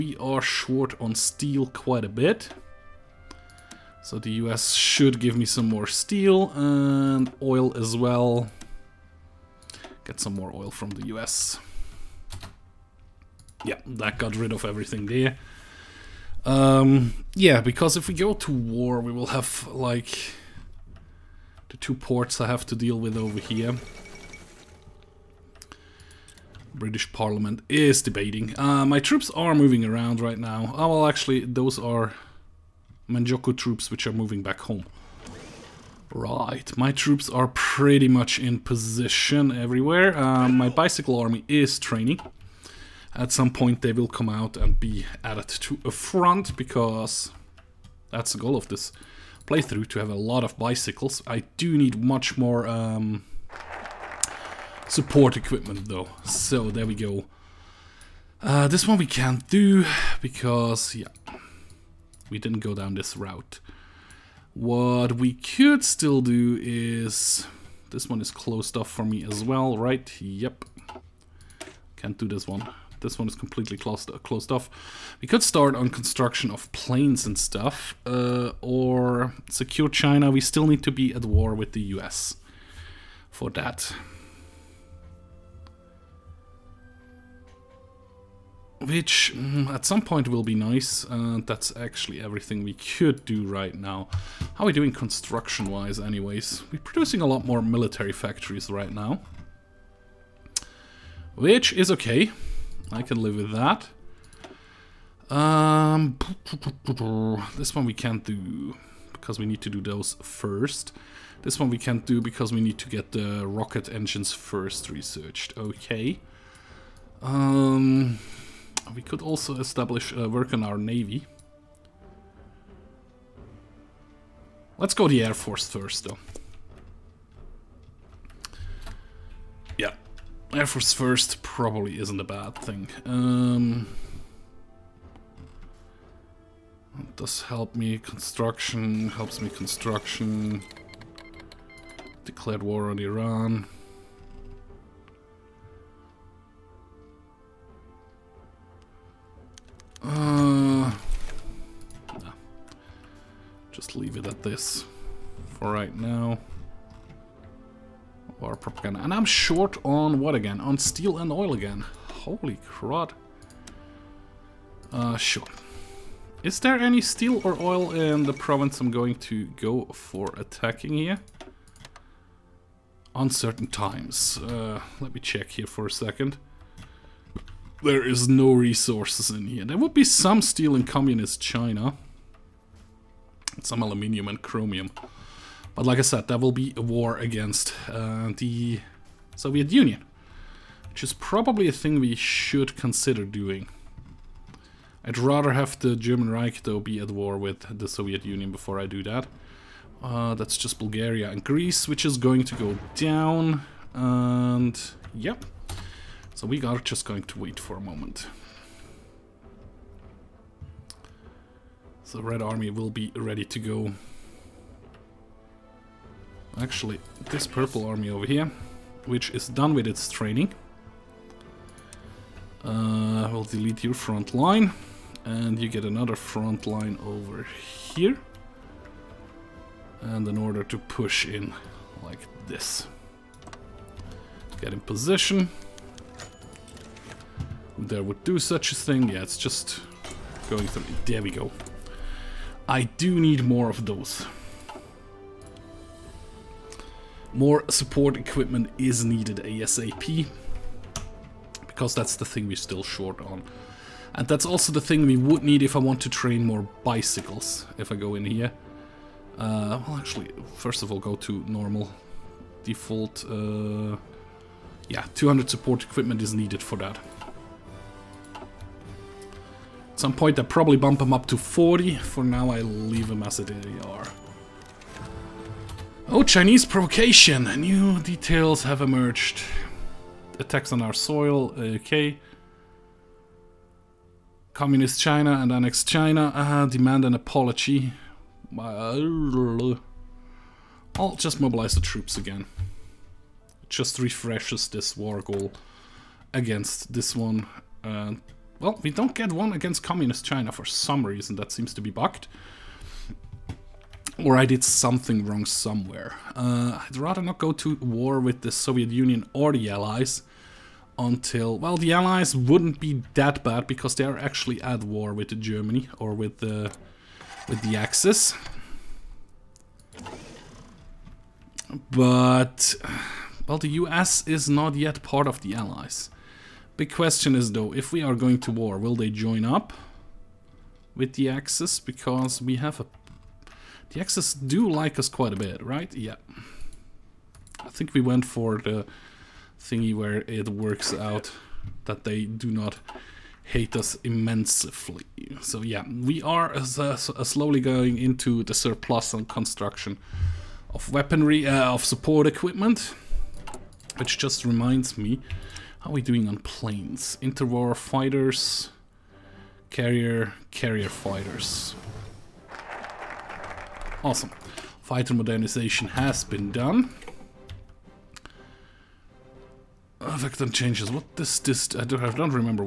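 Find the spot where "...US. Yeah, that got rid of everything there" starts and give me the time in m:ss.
0:11.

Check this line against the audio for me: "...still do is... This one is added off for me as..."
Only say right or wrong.
wrong.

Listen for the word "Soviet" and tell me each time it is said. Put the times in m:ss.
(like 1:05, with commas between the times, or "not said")
3:09, 3:17, 5:08.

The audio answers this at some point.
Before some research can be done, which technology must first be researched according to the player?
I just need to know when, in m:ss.
1:53.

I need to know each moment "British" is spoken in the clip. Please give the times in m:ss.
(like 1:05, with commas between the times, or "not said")
0:26.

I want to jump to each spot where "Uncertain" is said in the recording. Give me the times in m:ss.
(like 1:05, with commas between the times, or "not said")
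2:53.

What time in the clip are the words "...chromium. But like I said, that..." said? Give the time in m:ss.
3:04.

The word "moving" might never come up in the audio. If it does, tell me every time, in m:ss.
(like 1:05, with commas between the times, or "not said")
0:29, 0:34.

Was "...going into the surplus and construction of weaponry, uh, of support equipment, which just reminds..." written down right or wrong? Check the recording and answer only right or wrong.
right.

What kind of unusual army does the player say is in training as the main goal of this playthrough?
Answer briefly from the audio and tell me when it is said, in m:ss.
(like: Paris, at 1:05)
Bicycle army, at 0:40.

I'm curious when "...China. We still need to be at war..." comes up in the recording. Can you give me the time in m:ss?
1:19.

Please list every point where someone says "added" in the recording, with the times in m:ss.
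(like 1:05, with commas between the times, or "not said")
0:45.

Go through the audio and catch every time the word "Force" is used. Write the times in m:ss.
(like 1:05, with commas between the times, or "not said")
2:05, 2:10.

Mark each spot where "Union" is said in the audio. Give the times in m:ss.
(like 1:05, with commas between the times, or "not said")
3:09, 3:18, 5:08.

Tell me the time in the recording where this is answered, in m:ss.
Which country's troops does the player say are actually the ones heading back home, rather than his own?
0:33.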